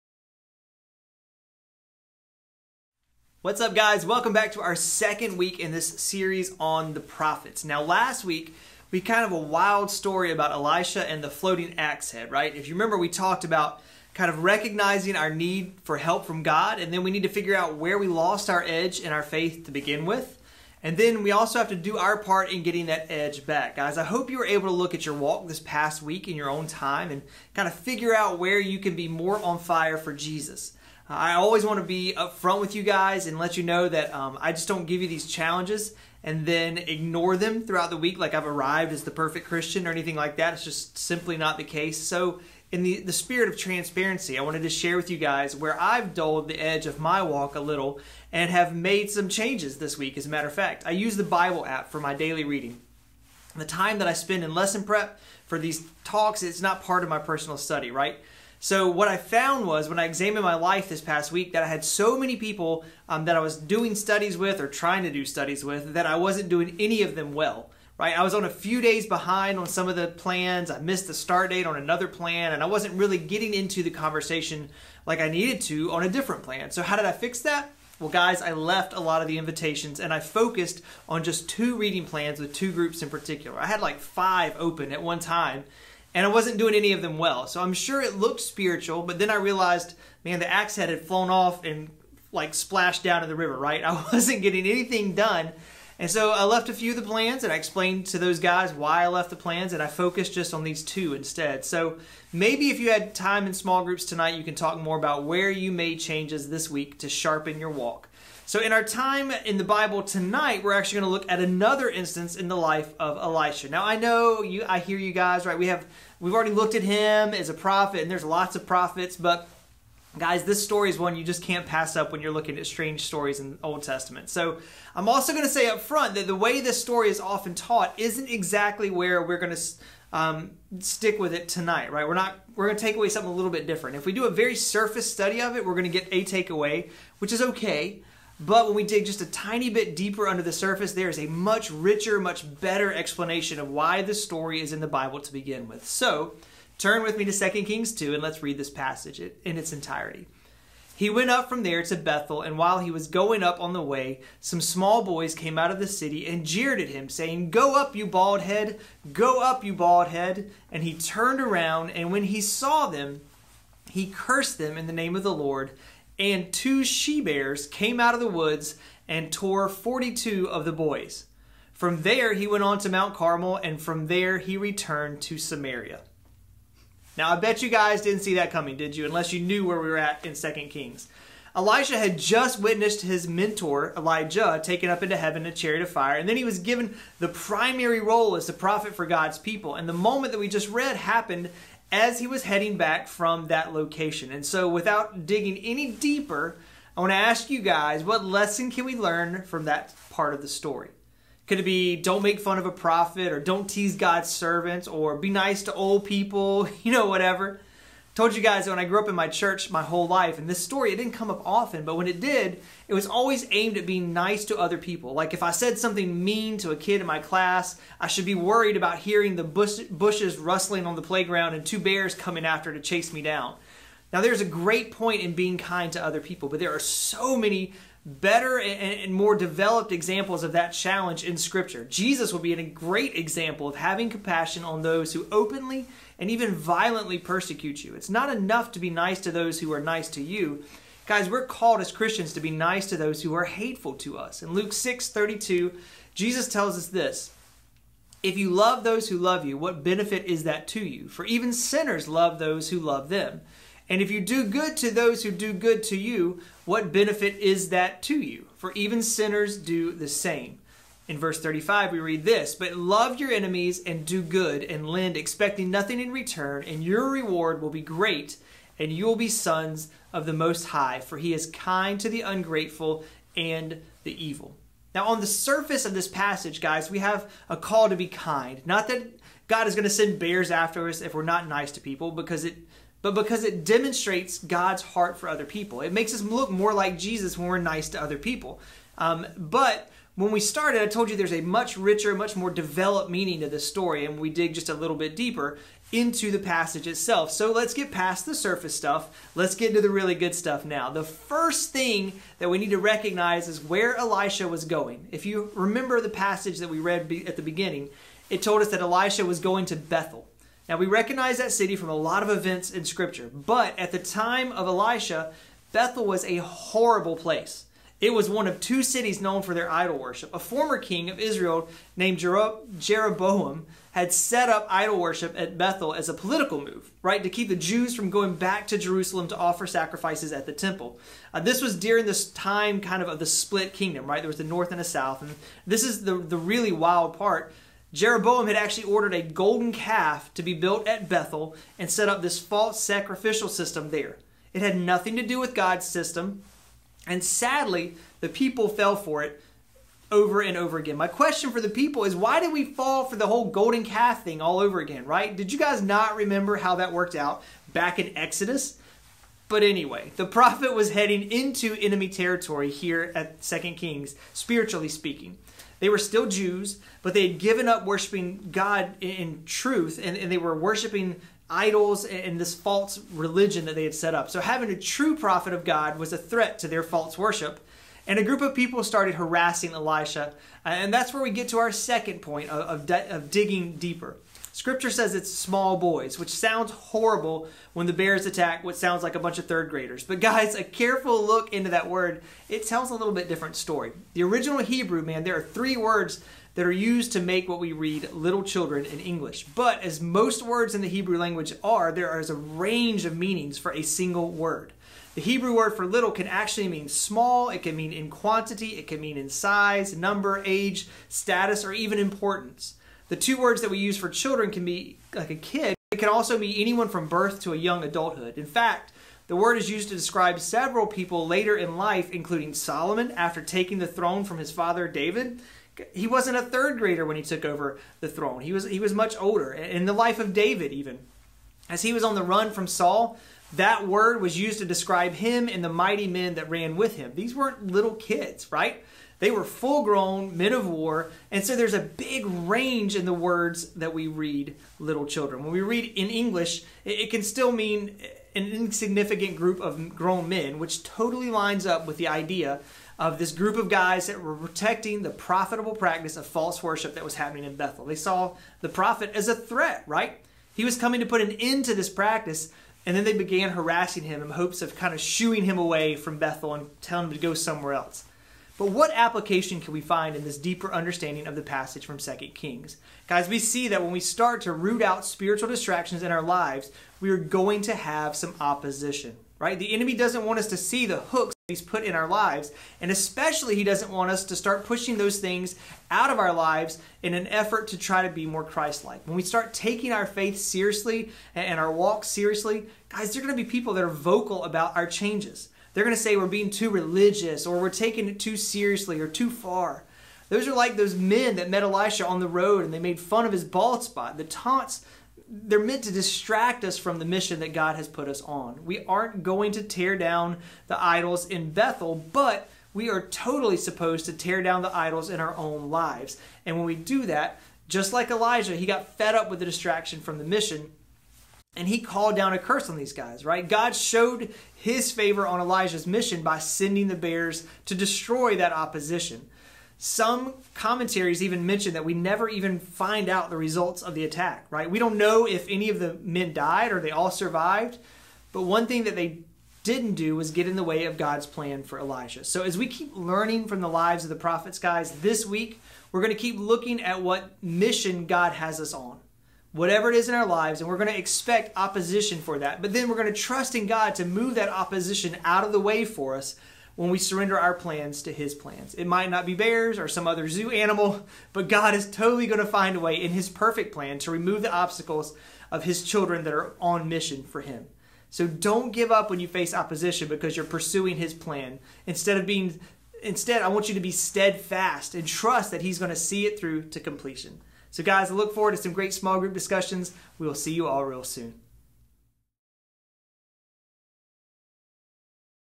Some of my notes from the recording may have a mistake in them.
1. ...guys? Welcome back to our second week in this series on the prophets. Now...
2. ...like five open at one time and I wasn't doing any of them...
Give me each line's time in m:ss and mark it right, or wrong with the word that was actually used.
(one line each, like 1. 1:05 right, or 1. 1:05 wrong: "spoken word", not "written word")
1. 0:03 right
2. 1:23 right.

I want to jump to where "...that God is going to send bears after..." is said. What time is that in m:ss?
4:38.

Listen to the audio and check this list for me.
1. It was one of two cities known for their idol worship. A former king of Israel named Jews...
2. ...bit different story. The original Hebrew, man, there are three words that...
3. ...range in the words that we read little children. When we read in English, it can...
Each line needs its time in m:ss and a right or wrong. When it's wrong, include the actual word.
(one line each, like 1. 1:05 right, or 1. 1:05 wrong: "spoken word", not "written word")
1. 5:18 wrong: "Jeroboam", not "Jews"
2. 6:33 right
3. 7:22 right.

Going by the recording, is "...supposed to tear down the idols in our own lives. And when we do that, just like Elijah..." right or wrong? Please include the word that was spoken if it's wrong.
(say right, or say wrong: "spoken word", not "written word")
right.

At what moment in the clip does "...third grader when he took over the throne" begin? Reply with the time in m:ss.
7:06.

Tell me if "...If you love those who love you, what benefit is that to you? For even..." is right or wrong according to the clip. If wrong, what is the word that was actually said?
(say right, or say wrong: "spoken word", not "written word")
right.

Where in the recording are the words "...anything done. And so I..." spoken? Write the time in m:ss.
1:34.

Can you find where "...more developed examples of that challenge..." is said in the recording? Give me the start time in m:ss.
3:49.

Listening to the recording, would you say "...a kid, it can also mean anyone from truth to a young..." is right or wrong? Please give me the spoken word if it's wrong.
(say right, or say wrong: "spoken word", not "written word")
wrong: "birth", not "truth".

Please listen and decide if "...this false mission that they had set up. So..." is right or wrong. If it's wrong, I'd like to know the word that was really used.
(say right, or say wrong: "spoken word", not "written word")
wrong: "religion", not "mission".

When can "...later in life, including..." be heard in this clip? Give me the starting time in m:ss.
7:01.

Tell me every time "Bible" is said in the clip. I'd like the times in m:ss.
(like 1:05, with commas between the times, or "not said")
0:51, 1:49, 2:24.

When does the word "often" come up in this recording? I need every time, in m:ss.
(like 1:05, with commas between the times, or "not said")
2:07, 3:31.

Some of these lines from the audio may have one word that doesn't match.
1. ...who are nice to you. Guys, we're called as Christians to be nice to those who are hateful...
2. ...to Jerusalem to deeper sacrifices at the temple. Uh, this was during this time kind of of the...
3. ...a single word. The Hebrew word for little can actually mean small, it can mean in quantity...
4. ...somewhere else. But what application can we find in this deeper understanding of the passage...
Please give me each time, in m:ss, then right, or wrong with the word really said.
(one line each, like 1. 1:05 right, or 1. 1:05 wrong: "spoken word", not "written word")
1. 3:59 right
2. 5:28 wrong: "offer", not "deeper"
3. 6:43 right
4. 7:47 right.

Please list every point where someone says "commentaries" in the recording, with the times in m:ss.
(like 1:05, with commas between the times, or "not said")
8:50.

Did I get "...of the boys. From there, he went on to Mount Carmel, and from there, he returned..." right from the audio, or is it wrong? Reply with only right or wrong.
right.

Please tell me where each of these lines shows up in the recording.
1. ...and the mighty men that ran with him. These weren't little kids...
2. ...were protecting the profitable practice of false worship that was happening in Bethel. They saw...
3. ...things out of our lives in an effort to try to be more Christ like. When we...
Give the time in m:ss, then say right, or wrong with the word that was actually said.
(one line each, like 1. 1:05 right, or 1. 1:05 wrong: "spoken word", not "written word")
1. 7:15 right
2. 7:34 right
3. 8:05 right.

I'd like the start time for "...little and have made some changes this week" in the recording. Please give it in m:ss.
0:47.